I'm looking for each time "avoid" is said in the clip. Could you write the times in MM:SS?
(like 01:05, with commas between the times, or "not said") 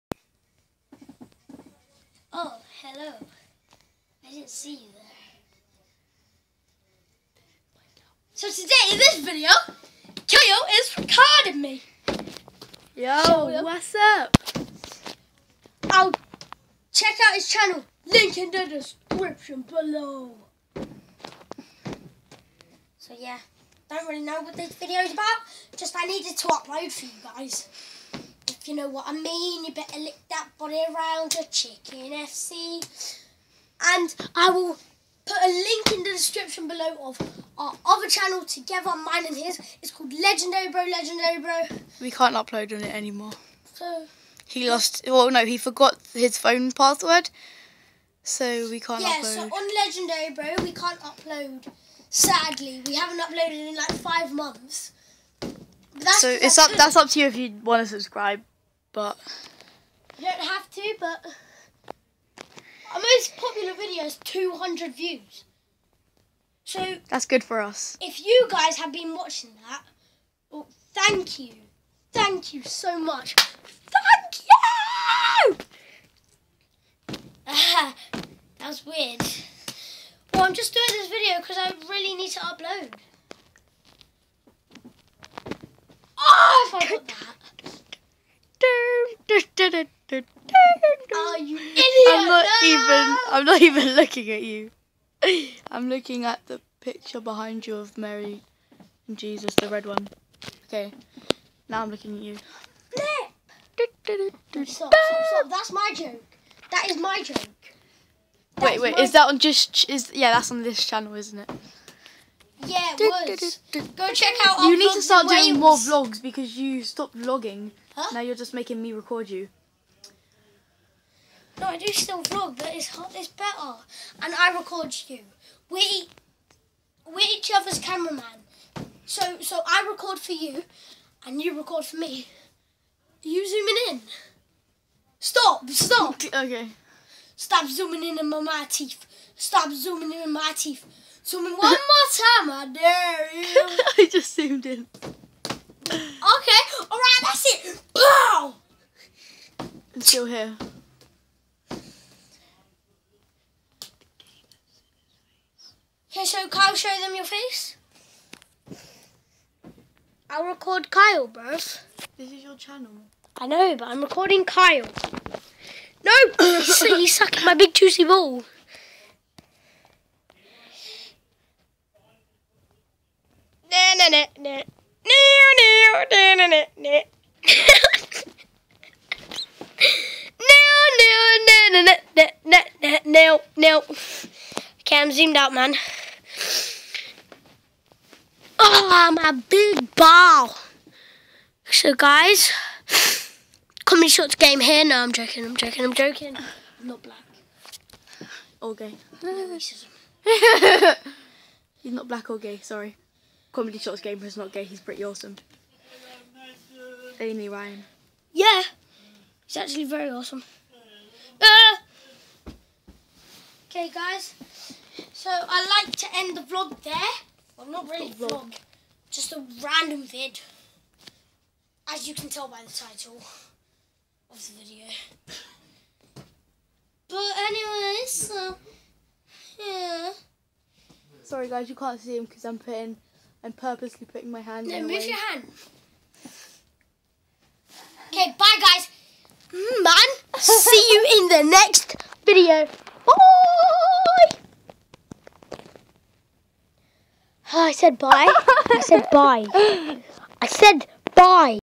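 not said.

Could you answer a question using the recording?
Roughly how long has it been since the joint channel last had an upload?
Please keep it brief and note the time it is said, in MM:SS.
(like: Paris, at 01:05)
five months, at 00:53.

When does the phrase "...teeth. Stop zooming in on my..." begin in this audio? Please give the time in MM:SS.
02:18.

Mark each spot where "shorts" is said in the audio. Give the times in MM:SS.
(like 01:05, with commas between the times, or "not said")
03:14, 03:23.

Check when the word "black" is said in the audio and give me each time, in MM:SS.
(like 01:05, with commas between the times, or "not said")
03:17, 03:22.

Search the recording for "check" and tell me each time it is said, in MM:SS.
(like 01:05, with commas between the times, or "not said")
00:16, 01:54.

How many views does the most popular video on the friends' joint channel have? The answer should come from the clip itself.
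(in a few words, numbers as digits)
200.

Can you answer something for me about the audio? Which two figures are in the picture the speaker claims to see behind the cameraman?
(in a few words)
Mary and Jesus.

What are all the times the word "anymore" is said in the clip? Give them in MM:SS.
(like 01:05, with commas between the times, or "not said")
00:42.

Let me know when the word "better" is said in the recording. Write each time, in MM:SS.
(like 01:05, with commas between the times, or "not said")
00:29, 02:03.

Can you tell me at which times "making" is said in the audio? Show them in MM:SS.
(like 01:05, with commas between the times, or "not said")
01:58.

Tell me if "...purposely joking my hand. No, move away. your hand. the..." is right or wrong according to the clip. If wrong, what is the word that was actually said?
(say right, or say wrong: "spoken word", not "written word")
wrong: "putting", not "joking".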